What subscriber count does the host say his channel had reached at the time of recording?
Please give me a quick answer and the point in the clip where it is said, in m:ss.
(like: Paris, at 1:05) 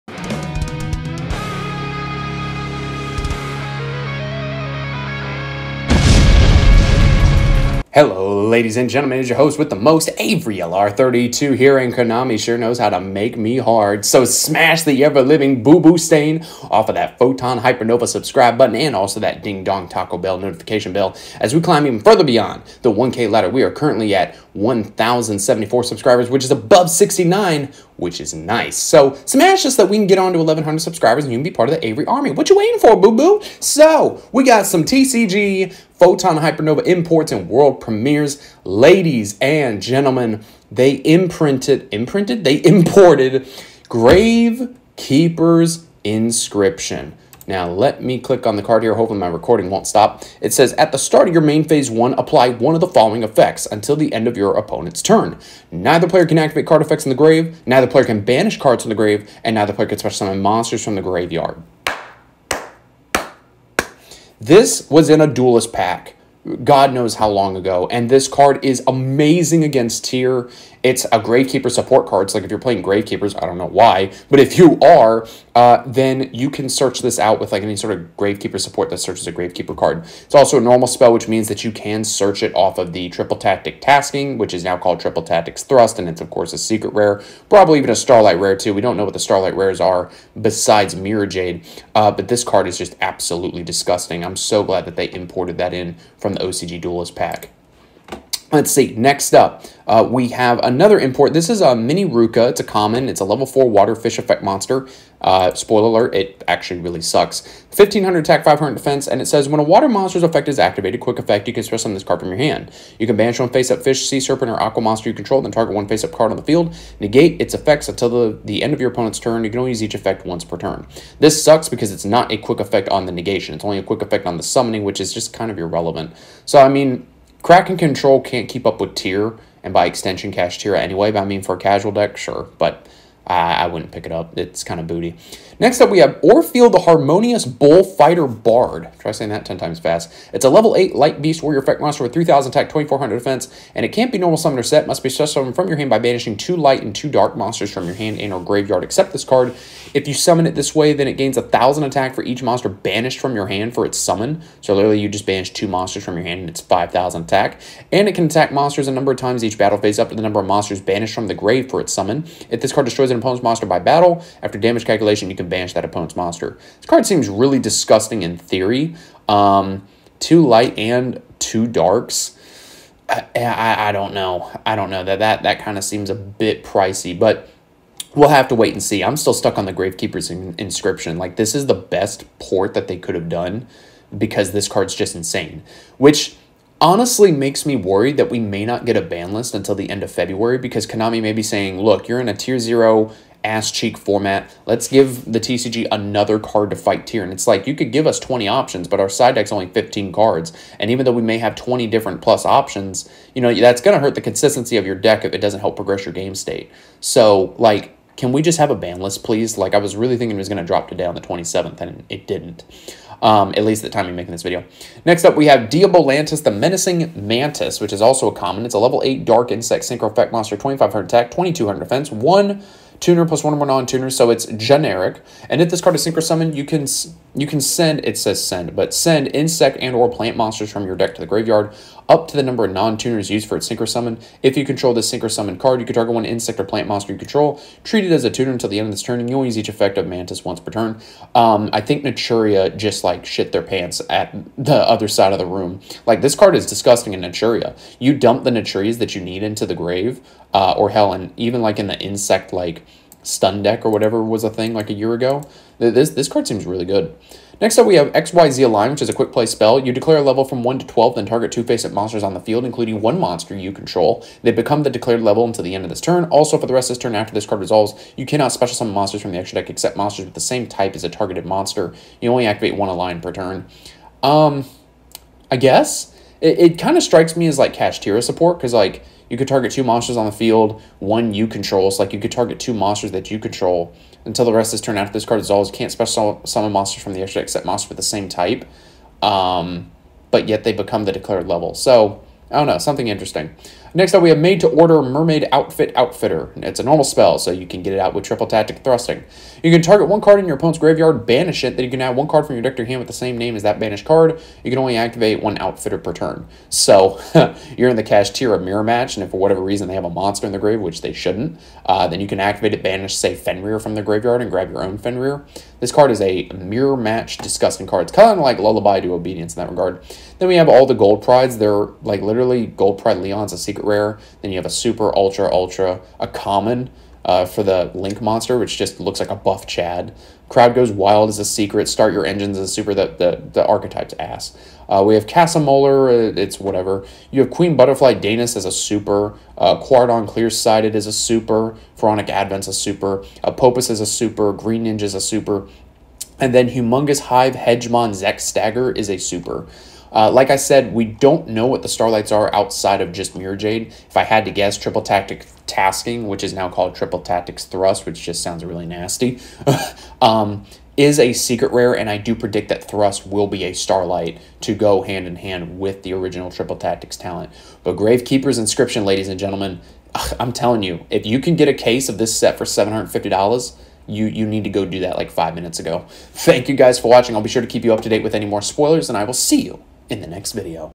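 1,074, at 0:24.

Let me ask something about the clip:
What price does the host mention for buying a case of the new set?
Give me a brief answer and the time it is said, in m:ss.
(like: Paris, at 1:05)
$750, at 6:12.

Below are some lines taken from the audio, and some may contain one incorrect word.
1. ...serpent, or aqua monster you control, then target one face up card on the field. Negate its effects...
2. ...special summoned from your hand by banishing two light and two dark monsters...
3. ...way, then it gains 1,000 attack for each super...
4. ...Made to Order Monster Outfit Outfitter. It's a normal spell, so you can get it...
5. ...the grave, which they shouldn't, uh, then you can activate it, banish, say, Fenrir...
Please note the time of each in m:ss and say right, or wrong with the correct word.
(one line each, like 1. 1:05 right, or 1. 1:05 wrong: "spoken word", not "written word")
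1. 1:54 right
2. 2:25 right
3. 2:30 wrong: "monster", not "super"
4. 4:54 wrong: "Mermaid", not "Monster"
5. 5:10 right.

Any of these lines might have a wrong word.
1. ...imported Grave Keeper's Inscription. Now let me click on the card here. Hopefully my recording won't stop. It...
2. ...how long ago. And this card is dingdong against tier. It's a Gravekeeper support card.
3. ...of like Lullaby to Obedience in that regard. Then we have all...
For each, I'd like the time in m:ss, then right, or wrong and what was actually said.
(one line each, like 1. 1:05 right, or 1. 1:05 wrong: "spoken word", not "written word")
1. 0:42 right
2. 1:07 wrong: "amazing", not "dingdong"
3. 5:18 right.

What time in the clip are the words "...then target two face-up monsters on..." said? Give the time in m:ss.
4:21.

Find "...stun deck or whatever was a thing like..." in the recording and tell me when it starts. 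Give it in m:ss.
4:13.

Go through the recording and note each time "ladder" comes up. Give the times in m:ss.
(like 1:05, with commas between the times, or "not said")
0:23.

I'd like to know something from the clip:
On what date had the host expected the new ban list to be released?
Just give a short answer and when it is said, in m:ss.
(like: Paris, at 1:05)
The 27th, at 3:31.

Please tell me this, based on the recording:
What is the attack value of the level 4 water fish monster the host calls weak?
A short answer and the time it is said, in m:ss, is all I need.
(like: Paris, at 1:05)
1500, at 1:47.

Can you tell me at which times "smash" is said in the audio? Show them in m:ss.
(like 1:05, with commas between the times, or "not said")
0:14, 0:29.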